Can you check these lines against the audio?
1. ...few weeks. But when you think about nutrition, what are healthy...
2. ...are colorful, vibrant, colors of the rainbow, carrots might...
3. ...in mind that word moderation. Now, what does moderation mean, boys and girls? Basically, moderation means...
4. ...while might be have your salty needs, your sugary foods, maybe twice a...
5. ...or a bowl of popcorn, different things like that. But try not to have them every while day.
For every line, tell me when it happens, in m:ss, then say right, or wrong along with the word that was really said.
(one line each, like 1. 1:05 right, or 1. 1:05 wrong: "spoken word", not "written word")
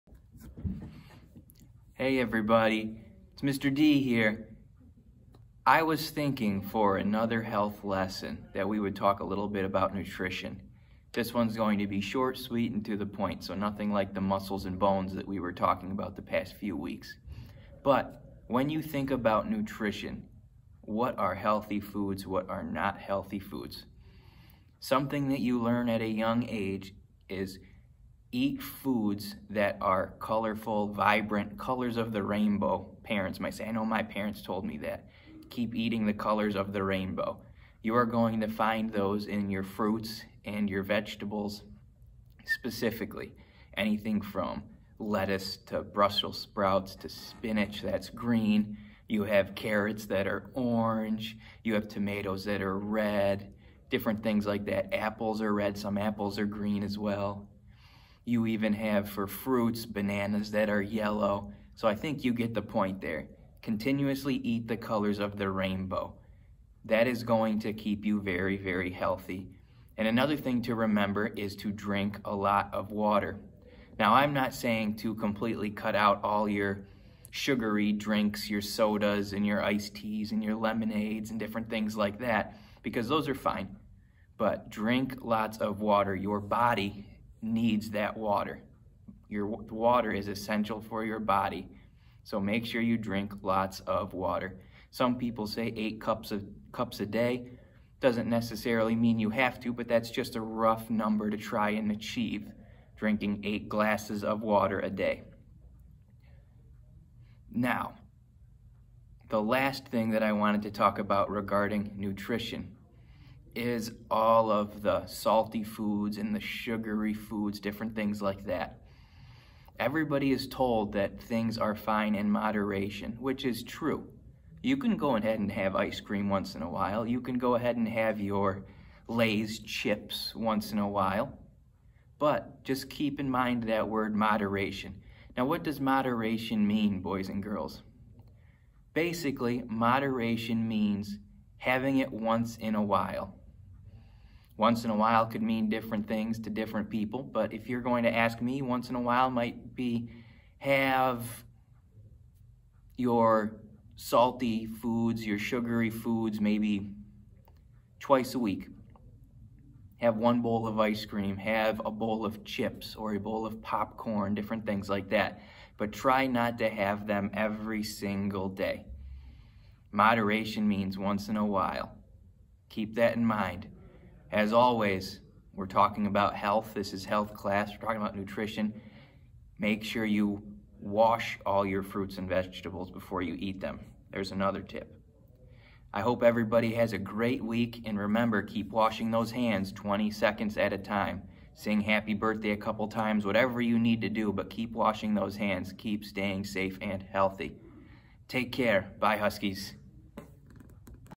1. 0:16 right
2. 0:29 wrong: "parents", not "carrots"
3. 2:13 right
4. 2:29 wrong: "foods", not "needs"
5. 2:42 wrong: "single", not "while".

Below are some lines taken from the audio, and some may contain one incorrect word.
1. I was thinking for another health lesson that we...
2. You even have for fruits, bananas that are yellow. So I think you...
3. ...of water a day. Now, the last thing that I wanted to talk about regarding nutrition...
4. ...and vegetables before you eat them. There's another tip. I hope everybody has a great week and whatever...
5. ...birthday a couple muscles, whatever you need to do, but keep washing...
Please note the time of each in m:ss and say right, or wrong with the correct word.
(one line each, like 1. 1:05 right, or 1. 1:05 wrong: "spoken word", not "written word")
1. 0:05 right
2. 0:58 right
3. 1:44 right
4. 3:02 wrong: "remember", not "whatever"
5. 3:12 wrong: "times", not "muscles".